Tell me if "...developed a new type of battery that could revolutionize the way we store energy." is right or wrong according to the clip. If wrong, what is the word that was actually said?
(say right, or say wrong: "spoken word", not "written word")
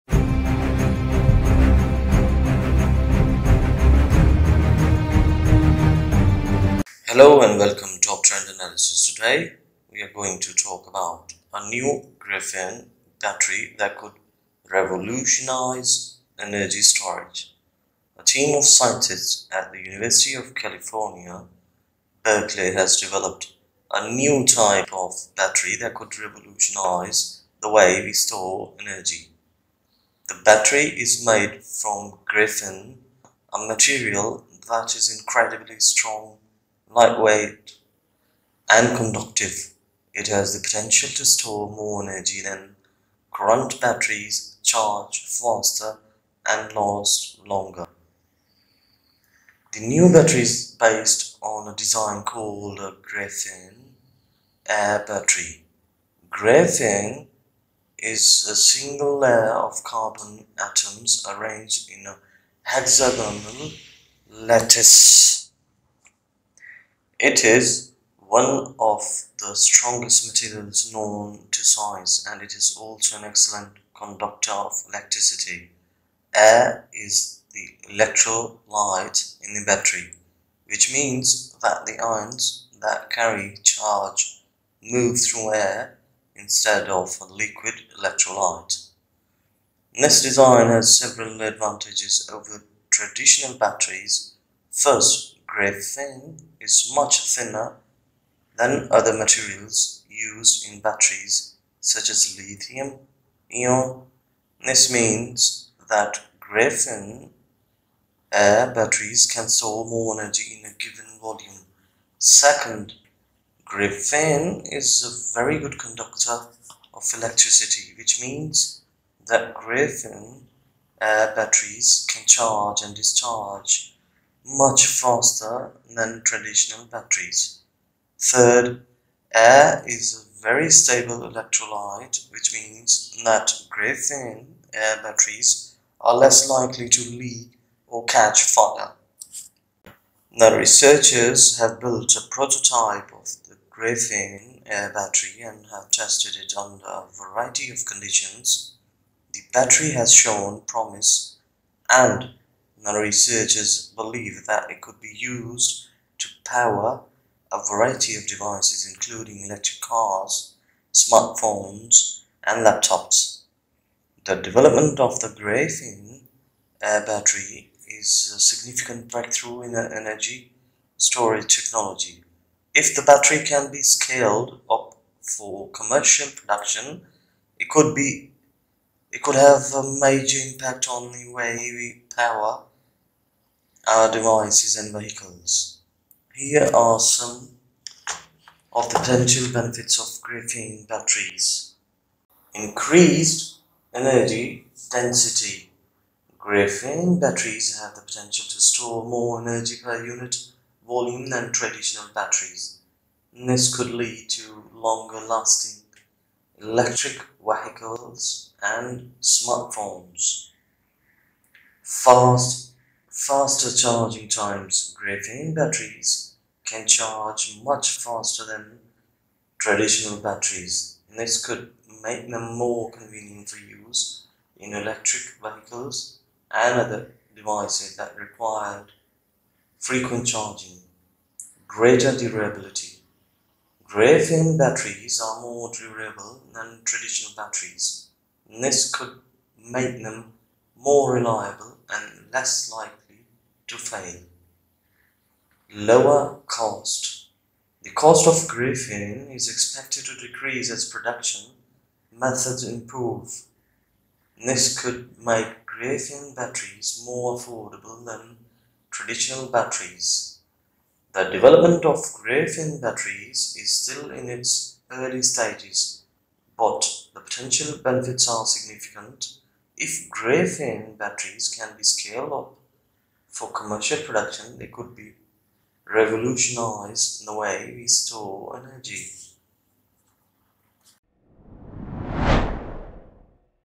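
right.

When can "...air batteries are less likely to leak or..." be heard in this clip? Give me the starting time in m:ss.
2:14.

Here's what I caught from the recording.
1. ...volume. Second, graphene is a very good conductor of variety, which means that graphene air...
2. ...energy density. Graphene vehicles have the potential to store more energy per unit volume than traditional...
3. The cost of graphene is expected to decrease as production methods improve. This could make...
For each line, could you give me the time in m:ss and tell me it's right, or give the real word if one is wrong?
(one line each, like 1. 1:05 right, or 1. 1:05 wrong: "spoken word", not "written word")
1. 1:51 wrong: "electricity", not "variety"
2. 3:13 wrong: "batteries", not "vehicles"
3. 4:07 right.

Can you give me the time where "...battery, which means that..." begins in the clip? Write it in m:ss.
1:19.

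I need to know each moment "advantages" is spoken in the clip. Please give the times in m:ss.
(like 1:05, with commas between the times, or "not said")
1:31.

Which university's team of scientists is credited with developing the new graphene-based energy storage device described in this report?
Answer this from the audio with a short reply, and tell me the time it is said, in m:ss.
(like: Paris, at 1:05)
University of California, Berkeley, at 0:19.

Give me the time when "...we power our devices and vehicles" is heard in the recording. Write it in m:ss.
3:01.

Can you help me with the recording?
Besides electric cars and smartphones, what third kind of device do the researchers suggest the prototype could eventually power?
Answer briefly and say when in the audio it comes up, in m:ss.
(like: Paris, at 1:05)
Laptops, at 2:42.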